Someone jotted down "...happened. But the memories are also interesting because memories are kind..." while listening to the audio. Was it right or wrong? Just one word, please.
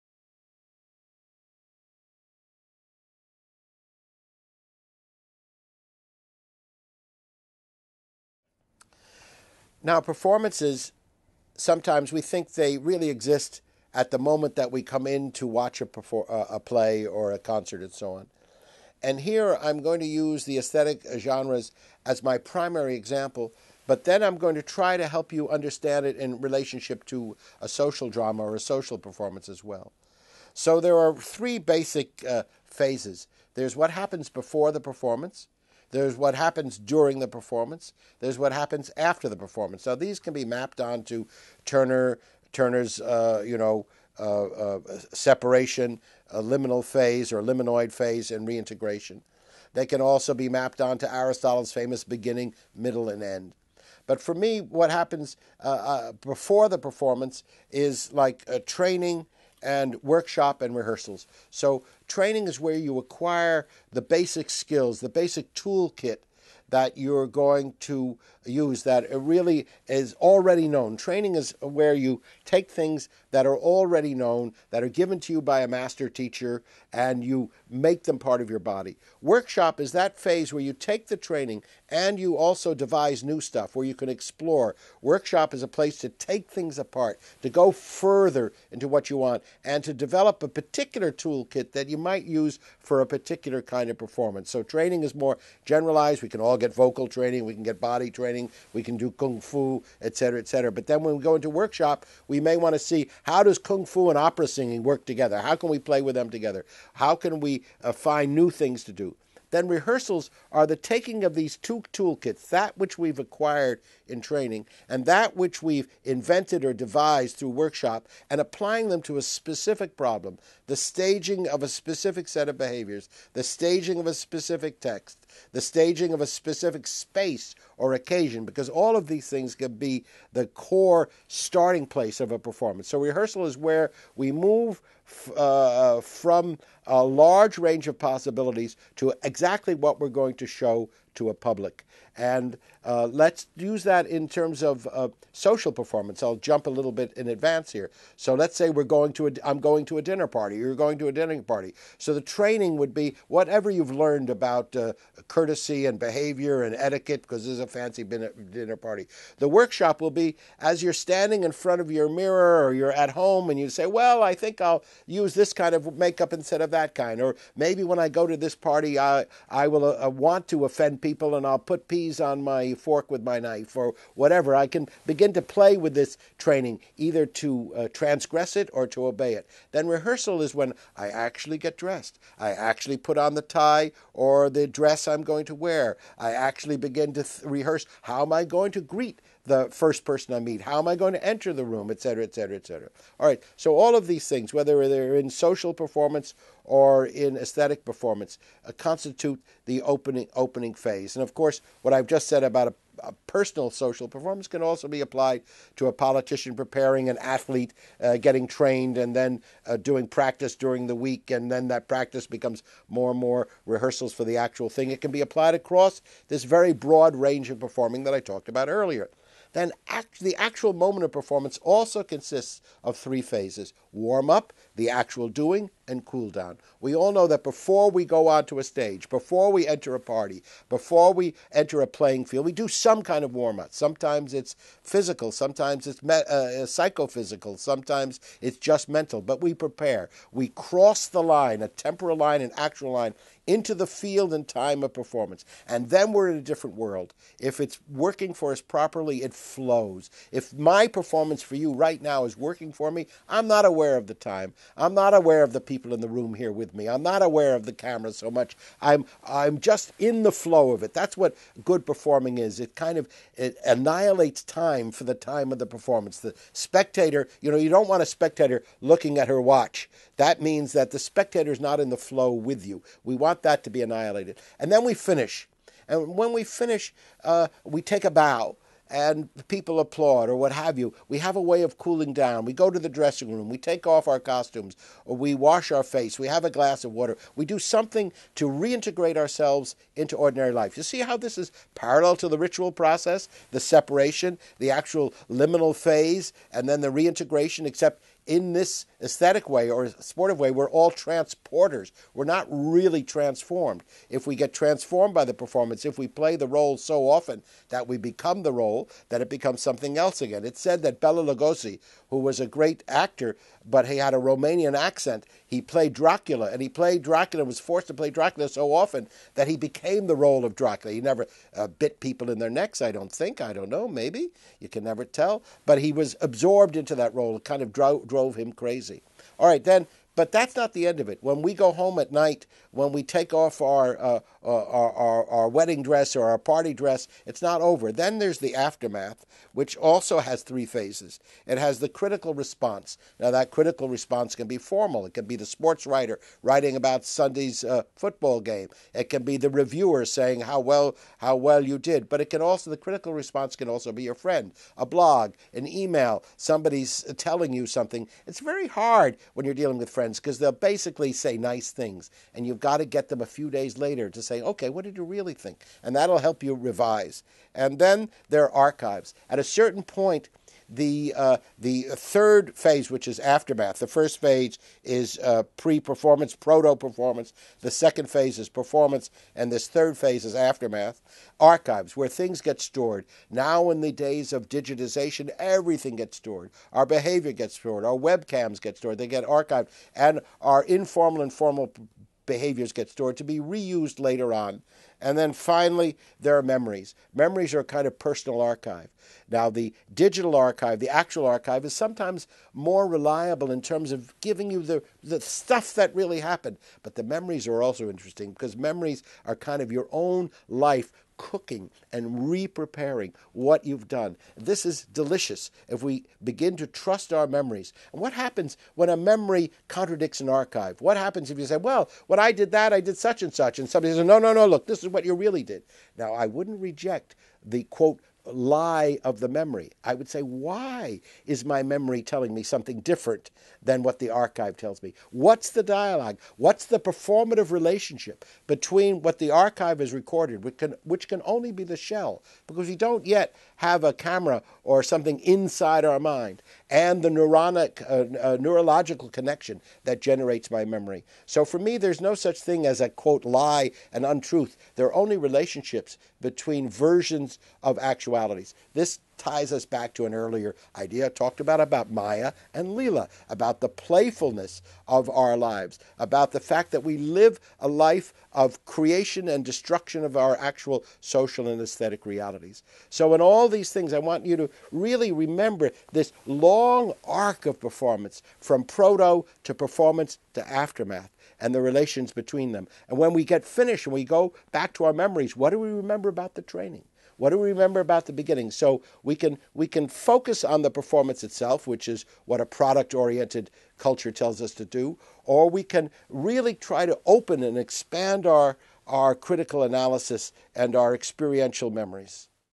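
right.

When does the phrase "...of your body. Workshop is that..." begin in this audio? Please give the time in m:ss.
1:18.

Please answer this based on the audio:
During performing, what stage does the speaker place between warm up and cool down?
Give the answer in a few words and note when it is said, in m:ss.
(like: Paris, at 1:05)
the actual doing, at 3:44.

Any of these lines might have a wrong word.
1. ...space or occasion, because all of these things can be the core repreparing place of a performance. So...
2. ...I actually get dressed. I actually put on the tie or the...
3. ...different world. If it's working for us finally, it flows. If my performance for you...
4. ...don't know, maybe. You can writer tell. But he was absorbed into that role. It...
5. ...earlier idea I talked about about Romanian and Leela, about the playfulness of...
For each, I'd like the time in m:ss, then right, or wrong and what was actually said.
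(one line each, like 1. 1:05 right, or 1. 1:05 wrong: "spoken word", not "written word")
1. 2:06 wrong: "starting", not "repreparing"
2. 3:00 right
3. 4:06 wrong: "properly", not "finally"
4. 5:23 wrong: "never", not "writer"
5. 7:40 wrong: "Maya", not "Romanian".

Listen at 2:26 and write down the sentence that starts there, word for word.
I'll jump a little bit in advance here.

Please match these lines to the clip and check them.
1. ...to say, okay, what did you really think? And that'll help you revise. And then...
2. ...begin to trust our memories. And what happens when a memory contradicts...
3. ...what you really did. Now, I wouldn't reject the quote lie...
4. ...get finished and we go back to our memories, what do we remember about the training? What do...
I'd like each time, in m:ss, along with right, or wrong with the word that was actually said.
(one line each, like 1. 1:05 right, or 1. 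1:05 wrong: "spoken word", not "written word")
1. 6:04 right
2. 6:56 right
3. 7:04 right
4. 8:03 right.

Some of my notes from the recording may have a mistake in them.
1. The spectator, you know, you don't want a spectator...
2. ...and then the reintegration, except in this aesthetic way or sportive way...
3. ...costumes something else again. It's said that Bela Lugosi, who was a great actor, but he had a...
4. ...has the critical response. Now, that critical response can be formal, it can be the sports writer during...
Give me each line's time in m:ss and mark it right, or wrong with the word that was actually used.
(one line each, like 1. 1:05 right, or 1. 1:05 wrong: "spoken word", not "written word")
1. 4:26 right
2. 4:56 right
3. 5:09 wrong: "becomes", not "costumes"
4. 5:41 wrong: "writing", not "during".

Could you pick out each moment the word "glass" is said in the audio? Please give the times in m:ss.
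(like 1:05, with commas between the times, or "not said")
4:46.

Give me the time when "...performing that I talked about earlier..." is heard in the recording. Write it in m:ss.
3:37.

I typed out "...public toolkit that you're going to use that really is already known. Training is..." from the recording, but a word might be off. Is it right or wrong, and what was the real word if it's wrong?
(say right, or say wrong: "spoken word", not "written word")
wrong: "basic", not "public".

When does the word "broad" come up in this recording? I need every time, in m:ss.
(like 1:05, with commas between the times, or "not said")
3:36.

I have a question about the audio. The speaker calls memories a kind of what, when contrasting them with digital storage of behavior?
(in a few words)
personal archive.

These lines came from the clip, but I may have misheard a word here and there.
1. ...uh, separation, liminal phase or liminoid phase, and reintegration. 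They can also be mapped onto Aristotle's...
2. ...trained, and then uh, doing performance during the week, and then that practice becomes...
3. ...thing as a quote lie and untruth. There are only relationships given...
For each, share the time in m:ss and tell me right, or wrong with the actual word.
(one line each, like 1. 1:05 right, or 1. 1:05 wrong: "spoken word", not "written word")
1. 0:44 right
2. 3:28 wrong: "practice", not "performance"
3. 7:32 wrong: "between", not "given".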